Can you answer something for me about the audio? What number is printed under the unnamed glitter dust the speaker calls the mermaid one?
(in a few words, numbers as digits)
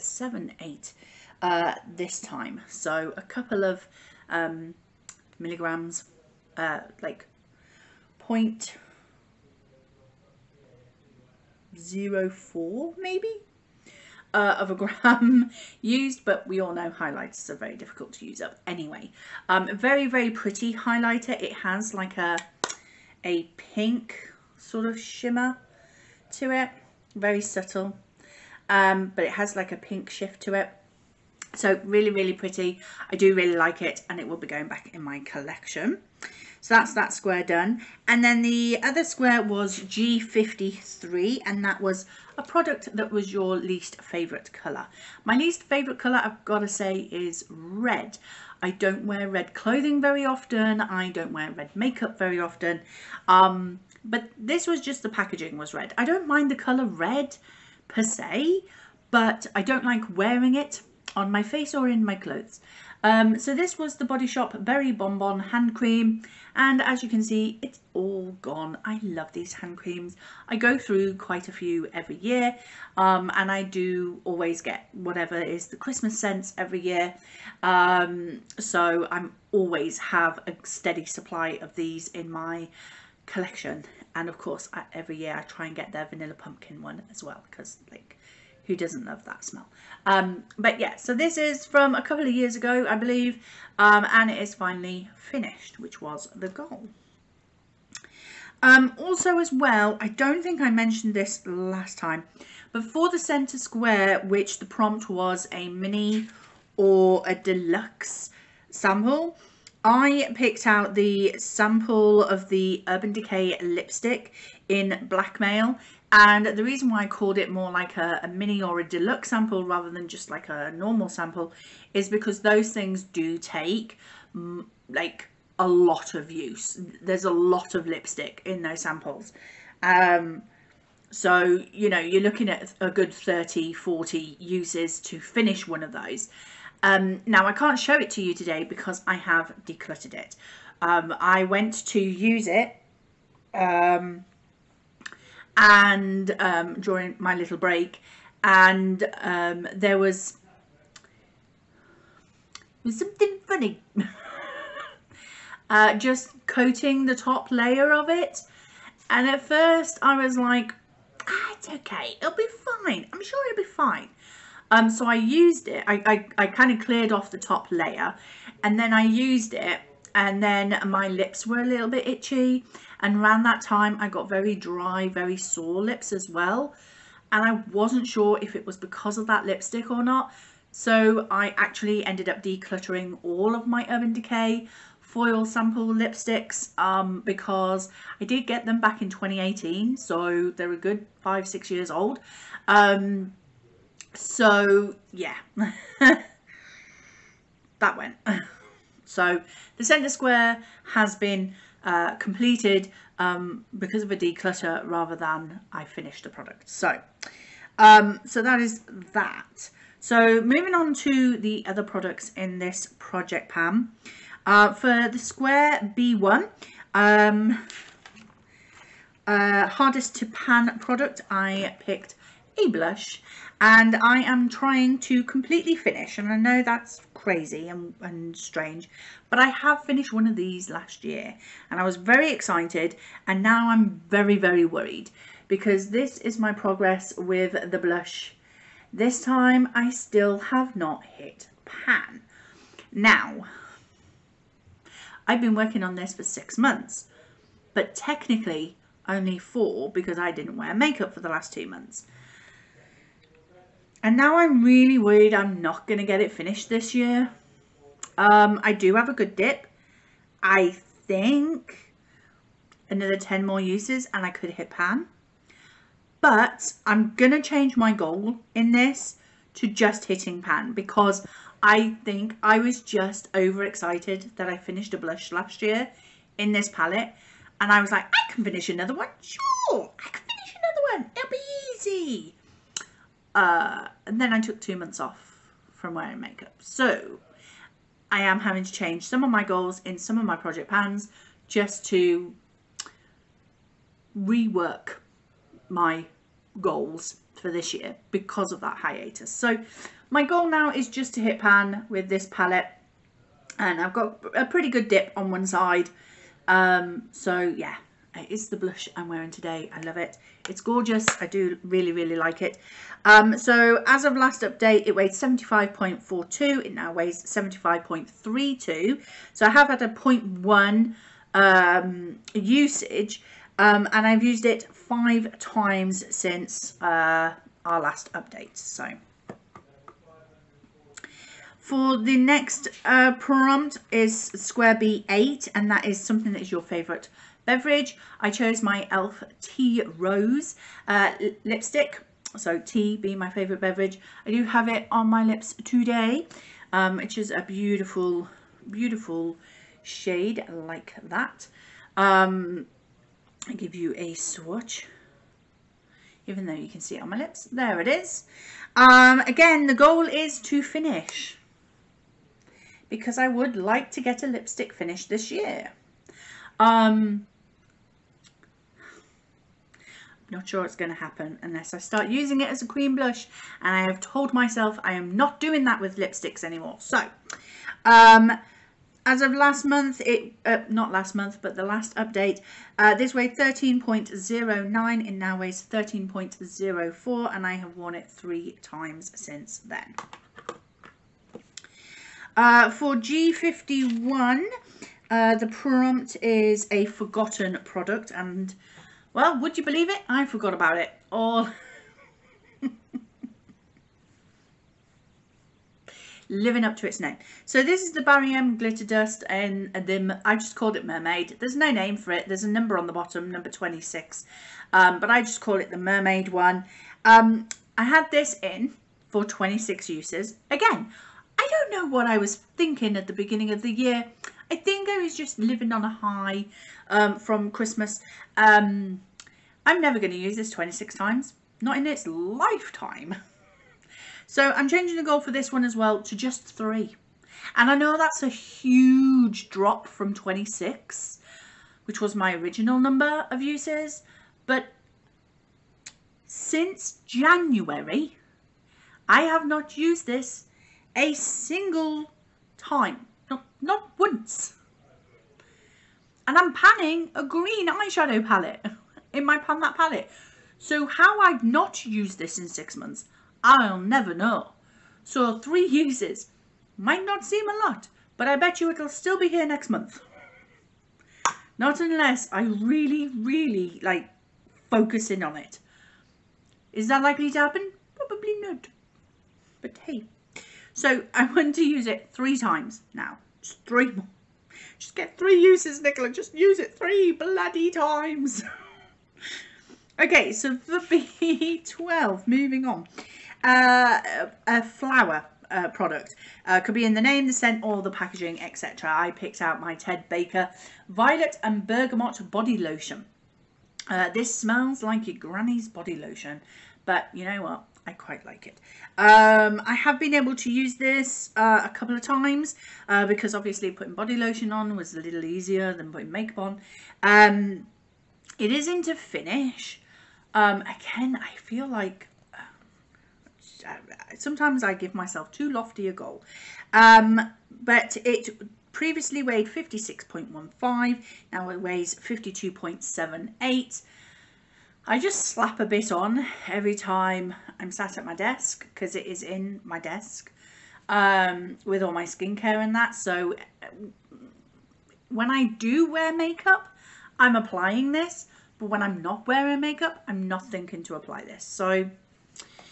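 26.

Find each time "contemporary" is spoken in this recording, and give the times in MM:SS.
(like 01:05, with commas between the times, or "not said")
not said.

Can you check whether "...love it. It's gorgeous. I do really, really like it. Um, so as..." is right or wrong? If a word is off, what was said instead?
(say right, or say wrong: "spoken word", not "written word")
right.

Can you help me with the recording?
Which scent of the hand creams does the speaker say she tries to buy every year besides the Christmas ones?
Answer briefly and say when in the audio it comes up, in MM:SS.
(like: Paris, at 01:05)
Vanilla pumpkin, at 01:26.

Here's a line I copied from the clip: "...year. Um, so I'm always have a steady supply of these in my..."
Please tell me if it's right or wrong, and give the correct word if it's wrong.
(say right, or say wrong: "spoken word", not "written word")
right.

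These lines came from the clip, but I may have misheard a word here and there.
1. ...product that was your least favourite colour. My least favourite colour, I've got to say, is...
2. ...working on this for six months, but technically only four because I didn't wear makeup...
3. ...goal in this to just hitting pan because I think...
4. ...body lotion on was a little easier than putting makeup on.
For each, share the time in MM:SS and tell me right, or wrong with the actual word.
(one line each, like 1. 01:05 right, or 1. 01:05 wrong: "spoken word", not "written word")
1. 00:42 right
2. 04:05 right
3. 04:27 right
4. 08:33 right.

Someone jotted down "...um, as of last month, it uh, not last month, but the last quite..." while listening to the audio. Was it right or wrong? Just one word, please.
wrong.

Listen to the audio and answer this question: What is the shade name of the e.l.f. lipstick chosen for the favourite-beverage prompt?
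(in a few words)
Tea Rose.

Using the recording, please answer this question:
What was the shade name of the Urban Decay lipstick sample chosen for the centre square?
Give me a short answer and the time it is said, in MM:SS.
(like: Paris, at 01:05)
Blackmail, at 01:55.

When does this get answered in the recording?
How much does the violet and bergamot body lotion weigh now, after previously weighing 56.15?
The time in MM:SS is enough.
08:51.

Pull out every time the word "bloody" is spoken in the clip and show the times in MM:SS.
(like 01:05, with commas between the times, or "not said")
08:07.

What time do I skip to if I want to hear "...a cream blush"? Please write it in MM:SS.
06:12.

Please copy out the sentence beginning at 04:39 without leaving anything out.
Sure, I can finish another one.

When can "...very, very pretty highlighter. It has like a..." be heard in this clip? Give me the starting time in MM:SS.
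00:19.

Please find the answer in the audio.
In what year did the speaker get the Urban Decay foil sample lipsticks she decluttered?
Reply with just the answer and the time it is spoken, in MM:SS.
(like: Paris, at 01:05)
2018, at 03:09.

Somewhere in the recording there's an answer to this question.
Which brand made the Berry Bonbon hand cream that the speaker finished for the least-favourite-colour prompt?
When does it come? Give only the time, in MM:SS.
01:04.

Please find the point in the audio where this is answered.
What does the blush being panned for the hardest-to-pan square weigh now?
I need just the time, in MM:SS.
05:17.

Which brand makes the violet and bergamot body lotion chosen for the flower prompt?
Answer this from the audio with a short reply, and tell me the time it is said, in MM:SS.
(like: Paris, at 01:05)
Ted Baker, at 08:19.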